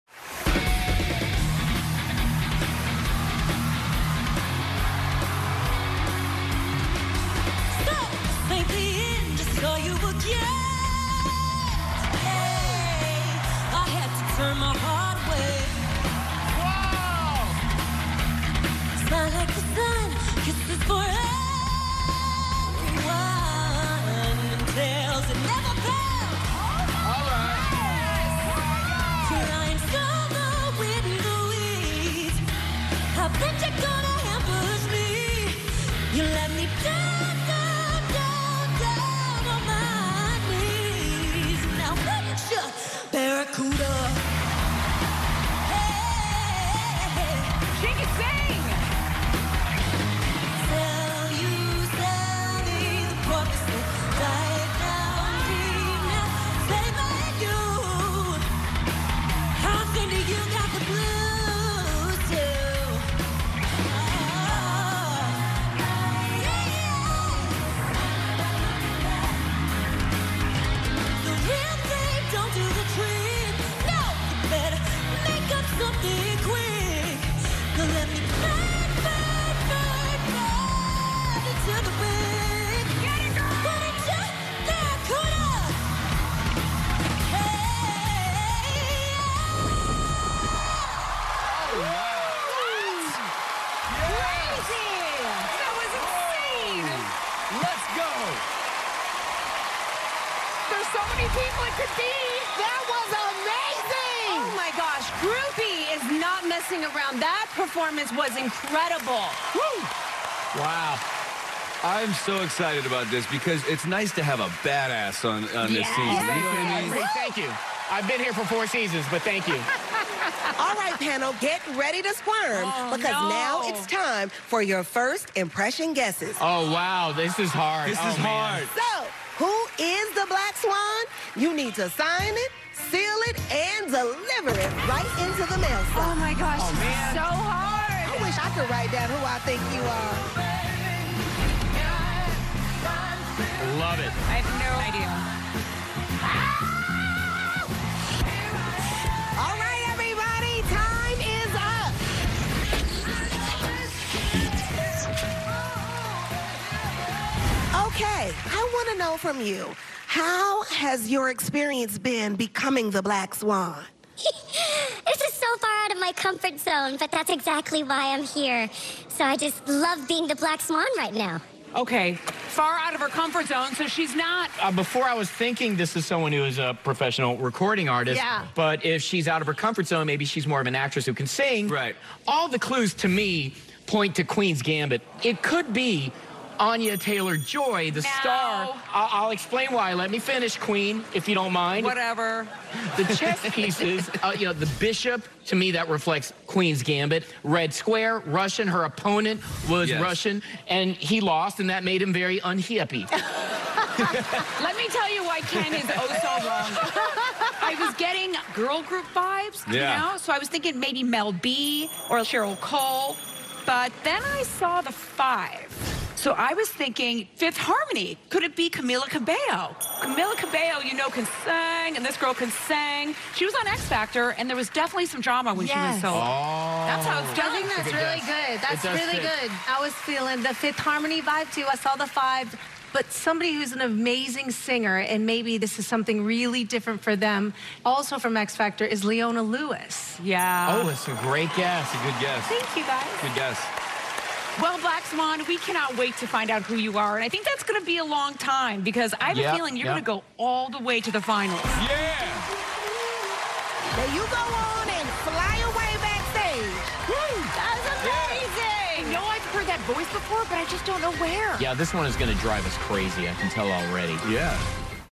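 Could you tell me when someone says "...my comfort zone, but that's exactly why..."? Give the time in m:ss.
2:45.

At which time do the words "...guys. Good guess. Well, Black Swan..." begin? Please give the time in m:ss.
4:02.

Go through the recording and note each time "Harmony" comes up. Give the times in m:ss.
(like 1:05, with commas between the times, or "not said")
3:37, 3:50.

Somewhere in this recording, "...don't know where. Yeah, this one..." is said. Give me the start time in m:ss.
4:20.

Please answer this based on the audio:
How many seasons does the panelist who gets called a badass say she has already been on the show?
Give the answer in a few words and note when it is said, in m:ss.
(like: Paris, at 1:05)
4, at 1:58.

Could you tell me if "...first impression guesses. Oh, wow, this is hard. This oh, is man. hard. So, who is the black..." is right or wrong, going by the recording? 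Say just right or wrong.
right.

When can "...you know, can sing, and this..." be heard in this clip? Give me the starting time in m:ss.
3:40.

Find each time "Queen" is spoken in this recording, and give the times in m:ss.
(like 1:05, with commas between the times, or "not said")
3:04, 3:10, 3:16.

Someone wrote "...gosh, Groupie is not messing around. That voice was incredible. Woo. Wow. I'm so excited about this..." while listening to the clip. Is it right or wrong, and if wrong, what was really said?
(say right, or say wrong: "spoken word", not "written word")
wrong: "performance", not "voice".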